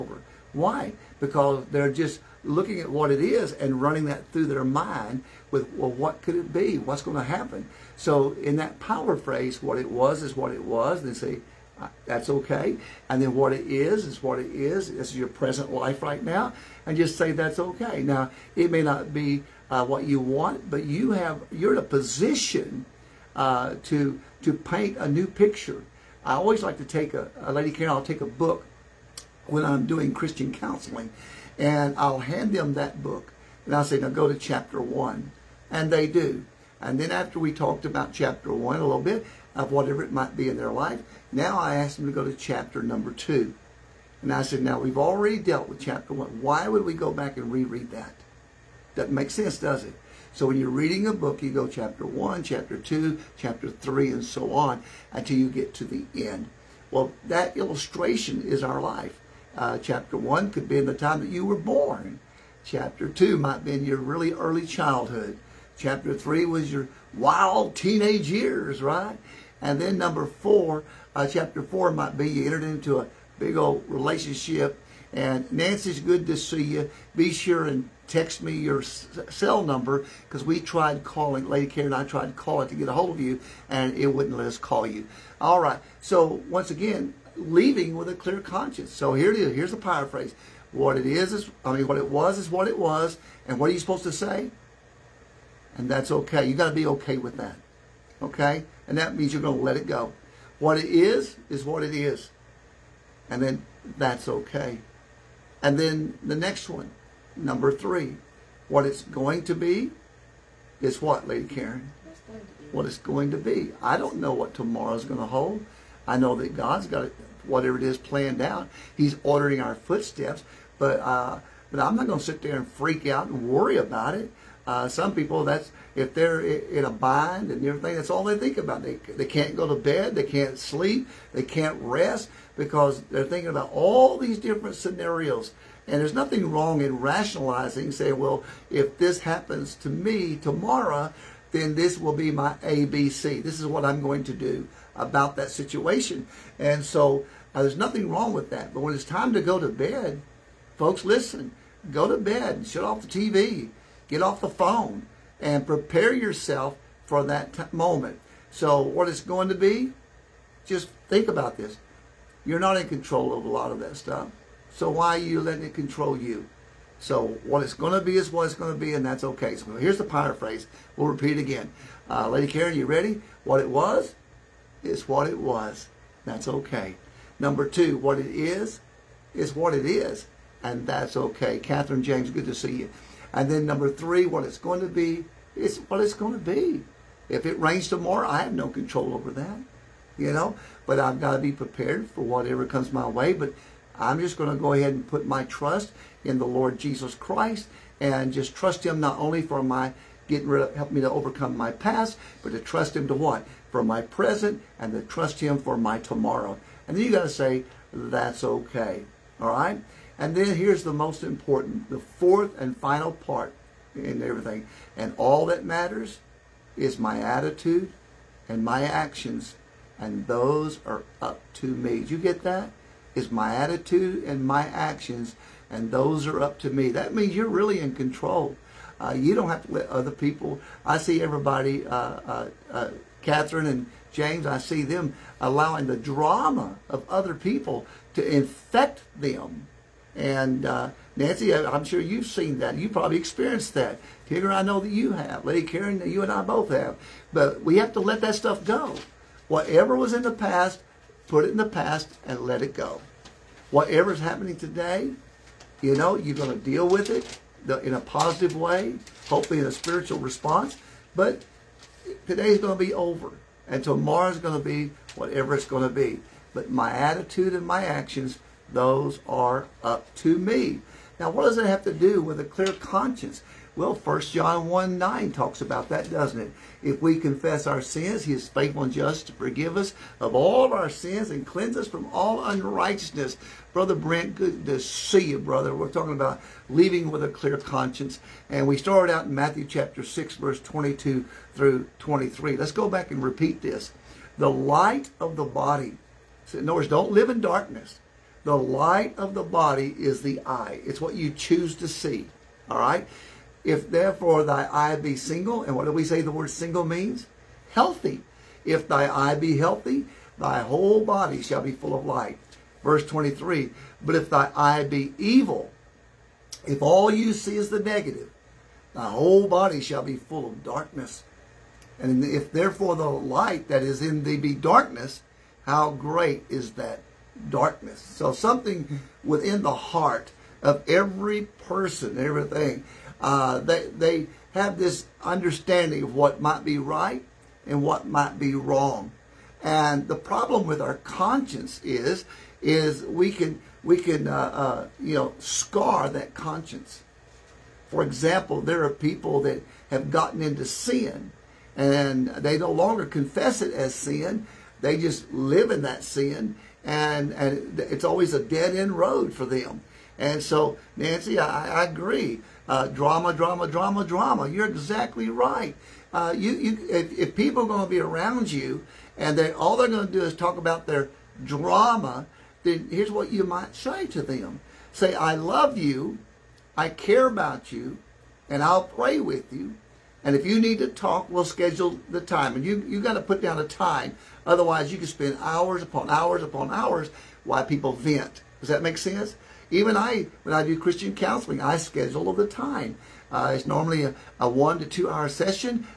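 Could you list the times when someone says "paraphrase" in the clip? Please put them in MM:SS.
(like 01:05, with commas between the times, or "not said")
01:29, 02:50.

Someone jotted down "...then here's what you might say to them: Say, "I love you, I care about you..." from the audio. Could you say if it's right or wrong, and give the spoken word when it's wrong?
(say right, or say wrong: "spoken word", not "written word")
right.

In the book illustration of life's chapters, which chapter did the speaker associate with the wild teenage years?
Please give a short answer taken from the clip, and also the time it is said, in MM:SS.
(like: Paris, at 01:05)
Chapter 3, at 01:05.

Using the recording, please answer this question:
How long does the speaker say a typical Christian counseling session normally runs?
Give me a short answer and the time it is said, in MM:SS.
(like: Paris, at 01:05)
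1 to 2 hours, at 06:34.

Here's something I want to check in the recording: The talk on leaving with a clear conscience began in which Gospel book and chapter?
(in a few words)
Matthew chapter 6.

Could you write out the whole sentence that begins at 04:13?
Whatever's happening today, you know, you're going to deal with it in a positive way, hopefully in a spiritual response.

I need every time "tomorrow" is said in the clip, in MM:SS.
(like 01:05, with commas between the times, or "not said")
01:54, 02:20, 03:07, 03:25, 04:23.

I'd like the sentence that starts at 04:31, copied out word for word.
Now, what does it have to do with a clear conscience?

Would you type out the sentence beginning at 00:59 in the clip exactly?
Uh, chapter 1 could be in the time that you were born.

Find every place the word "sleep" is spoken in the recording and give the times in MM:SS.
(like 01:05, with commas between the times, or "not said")
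02:10.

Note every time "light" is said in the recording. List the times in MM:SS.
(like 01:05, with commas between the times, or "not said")
04:54, 04:58, 05:12, 05:23.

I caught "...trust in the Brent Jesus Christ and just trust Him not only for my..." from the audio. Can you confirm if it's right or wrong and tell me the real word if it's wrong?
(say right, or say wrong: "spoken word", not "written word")
wrong: "Lord", not "Brent".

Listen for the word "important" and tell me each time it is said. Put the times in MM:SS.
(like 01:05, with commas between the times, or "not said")
03:31.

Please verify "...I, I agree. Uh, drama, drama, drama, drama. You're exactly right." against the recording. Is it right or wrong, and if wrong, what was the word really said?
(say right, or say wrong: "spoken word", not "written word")
right.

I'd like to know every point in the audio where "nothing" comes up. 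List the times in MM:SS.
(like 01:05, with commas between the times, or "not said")
02:16, 02:27.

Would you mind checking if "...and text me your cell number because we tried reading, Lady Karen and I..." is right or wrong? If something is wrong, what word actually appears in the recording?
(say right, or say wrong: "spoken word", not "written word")
wrong: "calling", not "reading".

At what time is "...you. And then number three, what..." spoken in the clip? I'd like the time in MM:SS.
03:02.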